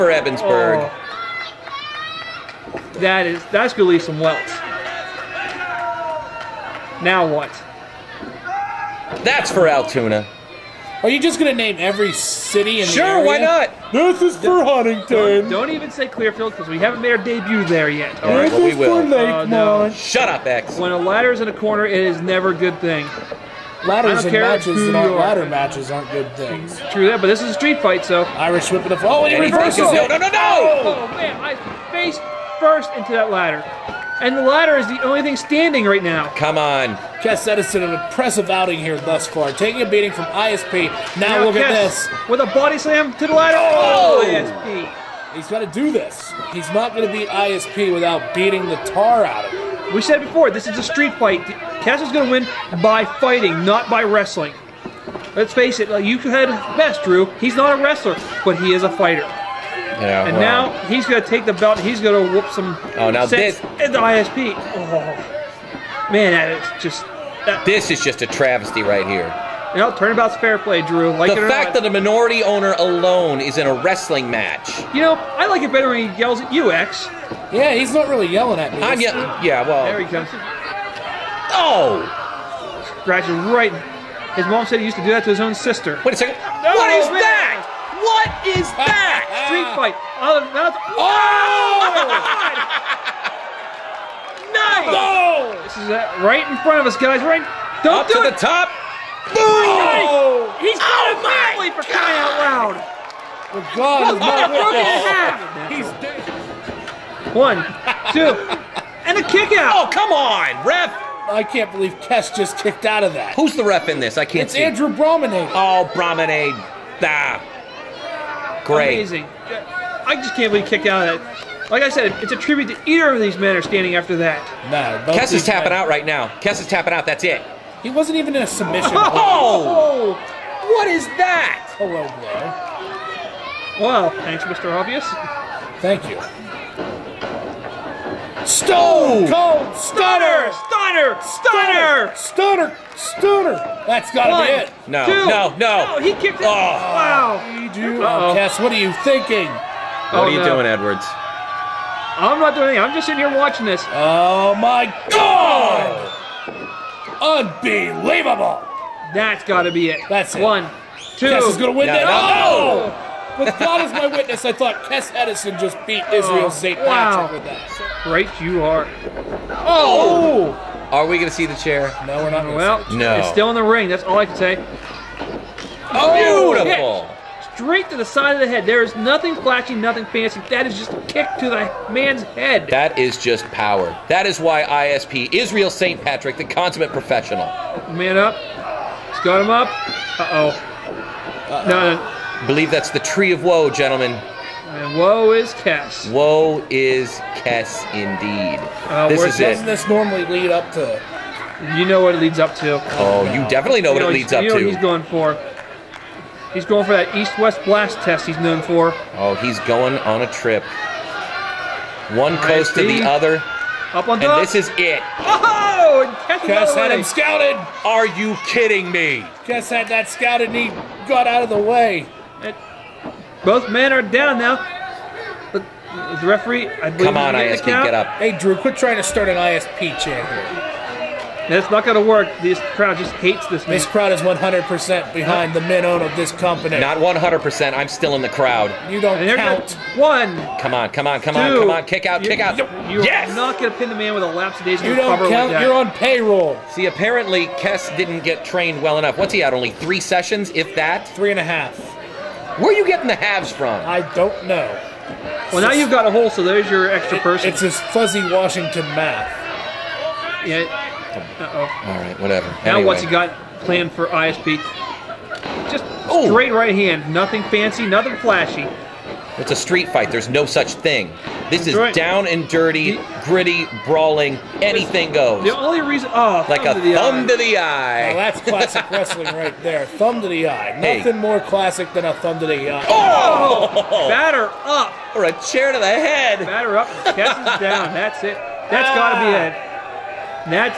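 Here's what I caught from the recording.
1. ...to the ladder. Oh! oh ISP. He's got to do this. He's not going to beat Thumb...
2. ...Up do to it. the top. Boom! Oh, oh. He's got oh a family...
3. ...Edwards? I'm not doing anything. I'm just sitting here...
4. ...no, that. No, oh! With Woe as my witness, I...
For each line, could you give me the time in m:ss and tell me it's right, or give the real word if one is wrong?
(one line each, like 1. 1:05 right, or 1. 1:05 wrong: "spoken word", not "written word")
1. 0:43 wrong: "ISP", not "Thumb"
2. 1:38 right
3. 2:30 right
4. 2:41 wrong: "God", not "Woe".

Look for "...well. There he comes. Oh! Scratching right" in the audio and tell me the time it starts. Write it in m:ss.
1:19.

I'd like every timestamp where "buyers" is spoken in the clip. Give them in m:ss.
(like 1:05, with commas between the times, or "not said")
not said.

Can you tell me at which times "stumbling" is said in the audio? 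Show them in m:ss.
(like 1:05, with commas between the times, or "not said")
not said.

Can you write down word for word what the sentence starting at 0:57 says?
He's not a wrestler, but he is a fighter and well, now he's going to take the belt.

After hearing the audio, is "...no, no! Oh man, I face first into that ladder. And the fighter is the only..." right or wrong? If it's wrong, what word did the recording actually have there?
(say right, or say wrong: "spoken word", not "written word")
wrong: "ladder", not "fighter".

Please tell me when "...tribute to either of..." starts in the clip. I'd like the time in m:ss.
2:02.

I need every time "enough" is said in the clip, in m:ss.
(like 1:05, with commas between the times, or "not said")
4:08.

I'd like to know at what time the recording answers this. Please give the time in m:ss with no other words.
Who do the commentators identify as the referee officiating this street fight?
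1:54.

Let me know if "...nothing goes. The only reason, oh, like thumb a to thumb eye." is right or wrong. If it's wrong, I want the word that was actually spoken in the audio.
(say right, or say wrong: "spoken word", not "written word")
wrong: "anything", not "nothing".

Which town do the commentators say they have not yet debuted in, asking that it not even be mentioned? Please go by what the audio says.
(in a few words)
Clearfield.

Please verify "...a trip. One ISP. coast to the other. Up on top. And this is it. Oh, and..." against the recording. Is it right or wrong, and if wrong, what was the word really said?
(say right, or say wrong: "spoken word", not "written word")
right.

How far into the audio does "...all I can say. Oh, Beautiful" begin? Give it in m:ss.
2:54.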